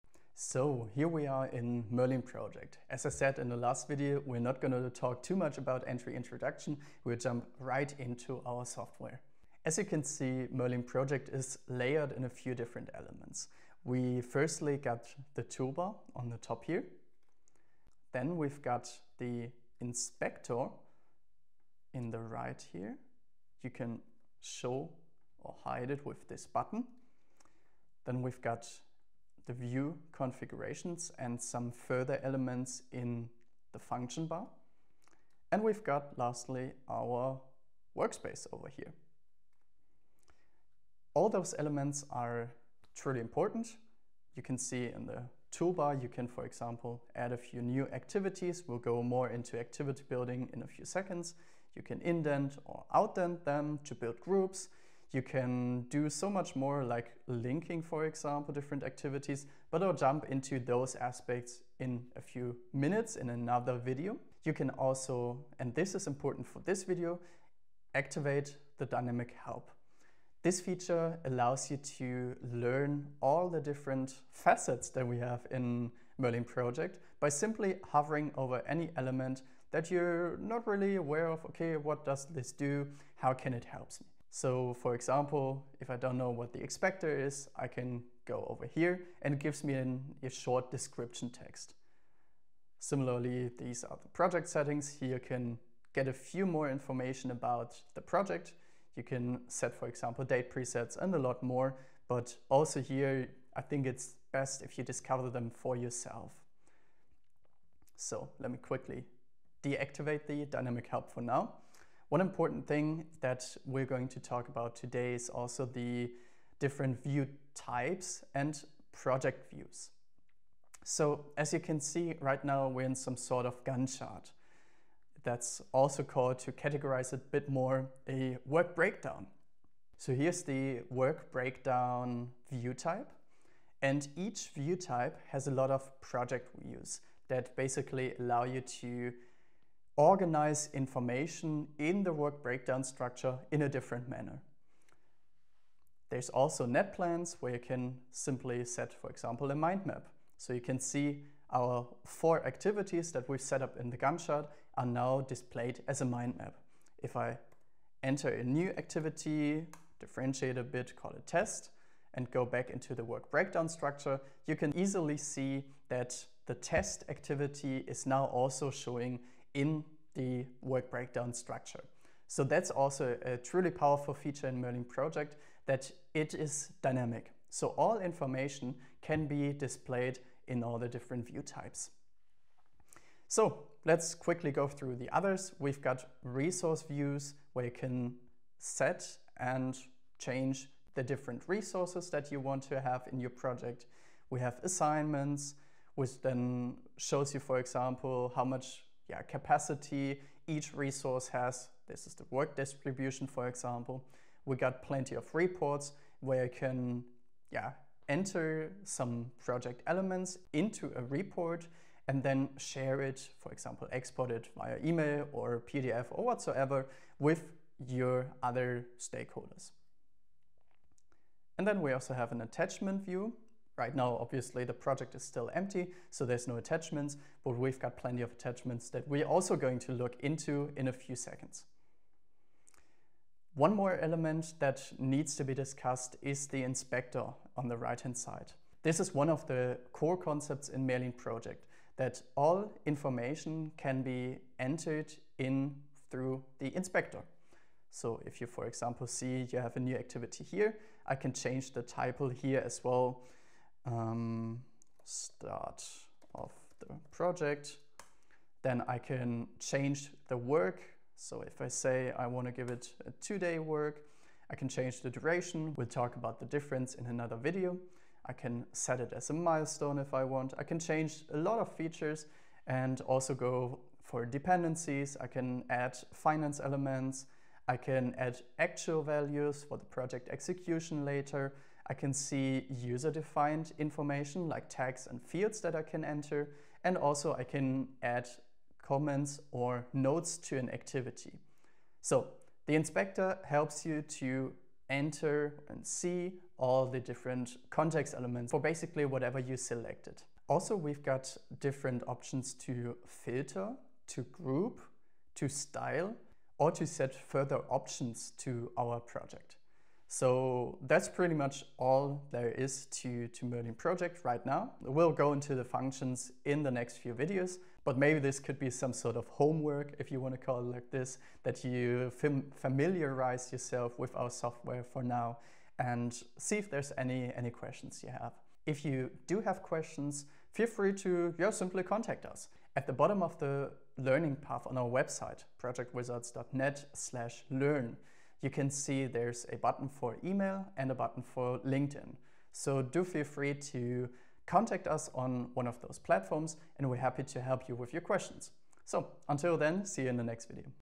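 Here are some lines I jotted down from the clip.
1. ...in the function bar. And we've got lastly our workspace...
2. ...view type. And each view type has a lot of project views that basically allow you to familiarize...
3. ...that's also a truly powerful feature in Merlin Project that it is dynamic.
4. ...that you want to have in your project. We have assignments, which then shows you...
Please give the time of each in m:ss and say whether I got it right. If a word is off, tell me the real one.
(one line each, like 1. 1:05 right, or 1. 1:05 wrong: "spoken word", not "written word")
1. 0:32 right
2. 2:12 wrong: "organize", not "familiarize"
3. 2:52 right
4. 3:12 right.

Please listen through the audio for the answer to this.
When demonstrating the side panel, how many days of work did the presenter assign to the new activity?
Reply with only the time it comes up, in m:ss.
4:23.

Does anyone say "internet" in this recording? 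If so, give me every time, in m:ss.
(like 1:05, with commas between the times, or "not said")
not said.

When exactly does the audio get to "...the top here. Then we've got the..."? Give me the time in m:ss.
0:16.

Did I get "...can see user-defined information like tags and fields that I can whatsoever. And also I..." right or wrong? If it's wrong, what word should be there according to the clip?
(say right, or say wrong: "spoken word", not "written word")
wrong: "enter", not "whatsoever".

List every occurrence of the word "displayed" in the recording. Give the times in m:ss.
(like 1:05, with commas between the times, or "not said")
2:35, 2:59.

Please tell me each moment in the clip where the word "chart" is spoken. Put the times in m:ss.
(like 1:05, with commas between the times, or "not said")
2:03, 2:34.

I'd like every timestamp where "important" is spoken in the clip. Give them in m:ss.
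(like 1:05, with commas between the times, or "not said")
0:43, 1:06, 1:52.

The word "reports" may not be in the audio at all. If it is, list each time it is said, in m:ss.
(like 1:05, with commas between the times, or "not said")
3:25, 3:31.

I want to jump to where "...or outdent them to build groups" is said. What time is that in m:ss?
0:52.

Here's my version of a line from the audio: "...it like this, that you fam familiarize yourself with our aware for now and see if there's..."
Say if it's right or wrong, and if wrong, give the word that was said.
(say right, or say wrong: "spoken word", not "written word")
wrong: "software", not "aware".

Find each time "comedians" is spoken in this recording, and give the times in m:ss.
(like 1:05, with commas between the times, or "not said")
not said.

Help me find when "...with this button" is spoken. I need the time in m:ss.
0:26.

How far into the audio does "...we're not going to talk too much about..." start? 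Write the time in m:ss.
0:04.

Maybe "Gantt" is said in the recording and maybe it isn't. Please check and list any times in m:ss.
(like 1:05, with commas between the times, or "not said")
2:03, 2:33.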